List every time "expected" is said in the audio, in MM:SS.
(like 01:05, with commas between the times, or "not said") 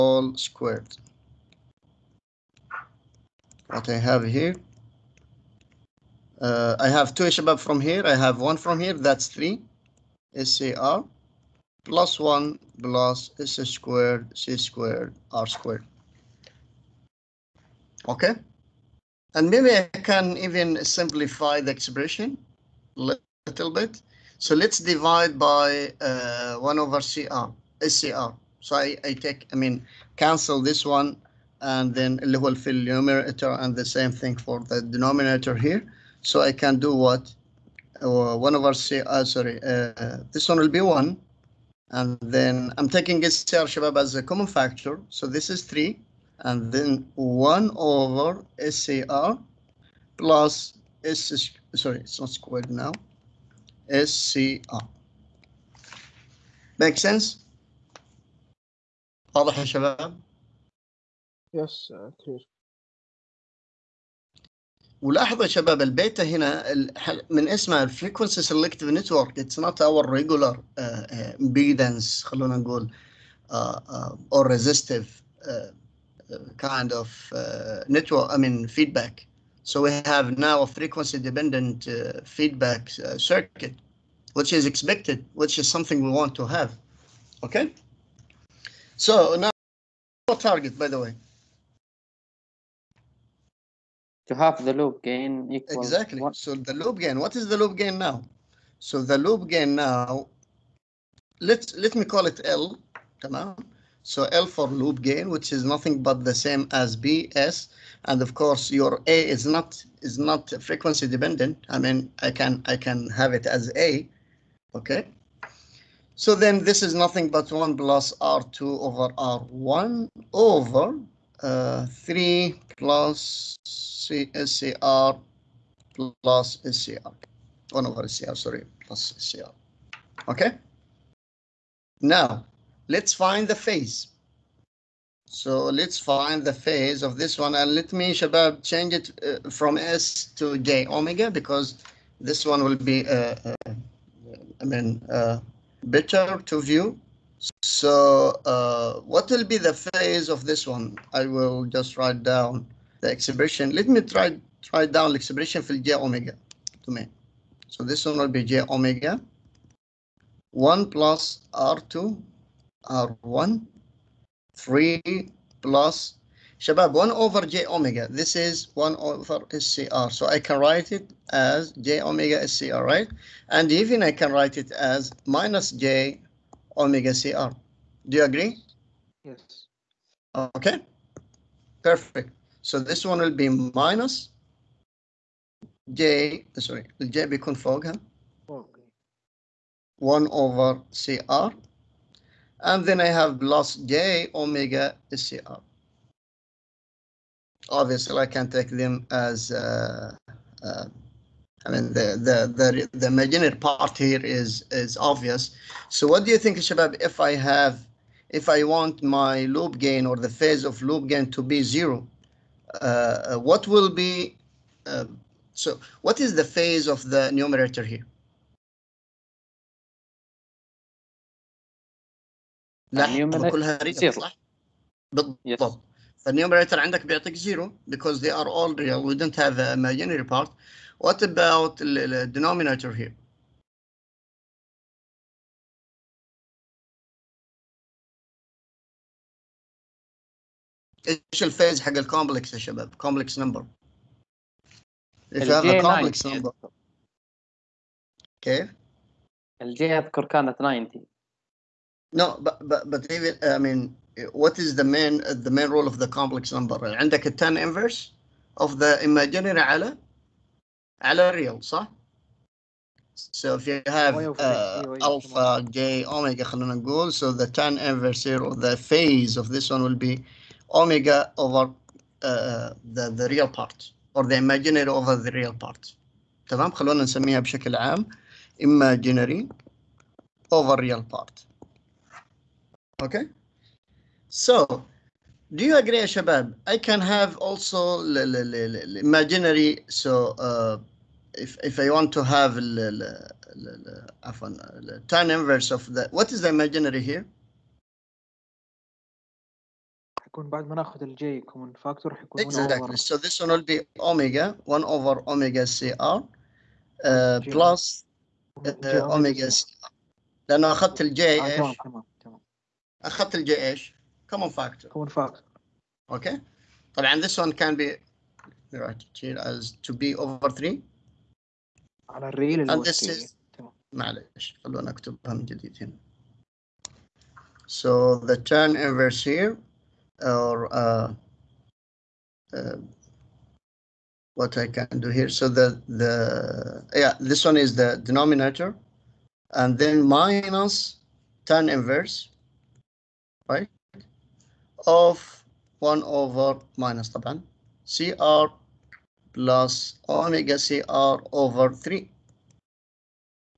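01:24.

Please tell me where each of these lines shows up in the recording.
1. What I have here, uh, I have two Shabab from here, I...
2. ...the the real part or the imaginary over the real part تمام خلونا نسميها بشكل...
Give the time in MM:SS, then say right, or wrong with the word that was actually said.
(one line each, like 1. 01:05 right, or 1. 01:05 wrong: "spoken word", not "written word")
1. 00:03 right
2. 04:32 right.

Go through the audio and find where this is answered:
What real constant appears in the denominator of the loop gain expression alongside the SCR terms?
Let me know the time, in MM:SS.
02:01.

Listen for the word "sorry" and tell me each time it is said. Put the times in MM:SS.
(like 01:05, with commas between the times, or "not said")
00:39, 00:51, 02:08, 03:06.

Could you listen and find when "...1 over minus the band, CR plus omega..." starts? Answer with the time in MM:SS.
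05:45.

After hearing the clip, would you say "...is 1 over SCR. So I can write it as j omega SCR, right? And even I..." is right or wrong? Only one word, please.
right.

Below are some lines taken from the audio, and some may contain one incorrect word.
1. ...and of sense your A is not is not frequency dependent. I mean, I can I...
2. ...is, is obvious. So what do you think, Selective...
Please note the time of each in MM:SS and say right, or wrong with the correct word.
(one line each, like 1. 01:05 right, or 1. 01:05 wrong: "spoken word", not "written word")
1. 01:48 wrong: "course", not "sense"
2. 03:24 wrong: "Shabab", not "Selective".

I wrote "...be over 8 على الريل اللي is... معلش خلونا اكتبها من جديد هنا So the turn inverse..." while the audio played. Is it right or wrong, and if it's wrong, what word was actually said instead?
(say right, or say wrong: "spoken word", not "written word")
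wrong: "3", not "8".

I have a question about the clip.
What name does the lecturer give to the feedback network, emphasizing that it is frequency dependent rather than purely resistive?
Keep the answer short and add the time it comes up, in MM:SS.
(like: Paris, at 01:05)
Selective Network, at 01:08.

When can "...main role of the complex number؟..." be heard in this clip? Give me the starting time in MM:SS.
04:15.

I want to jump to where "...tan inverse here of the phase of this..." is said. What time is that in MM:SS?
04:27.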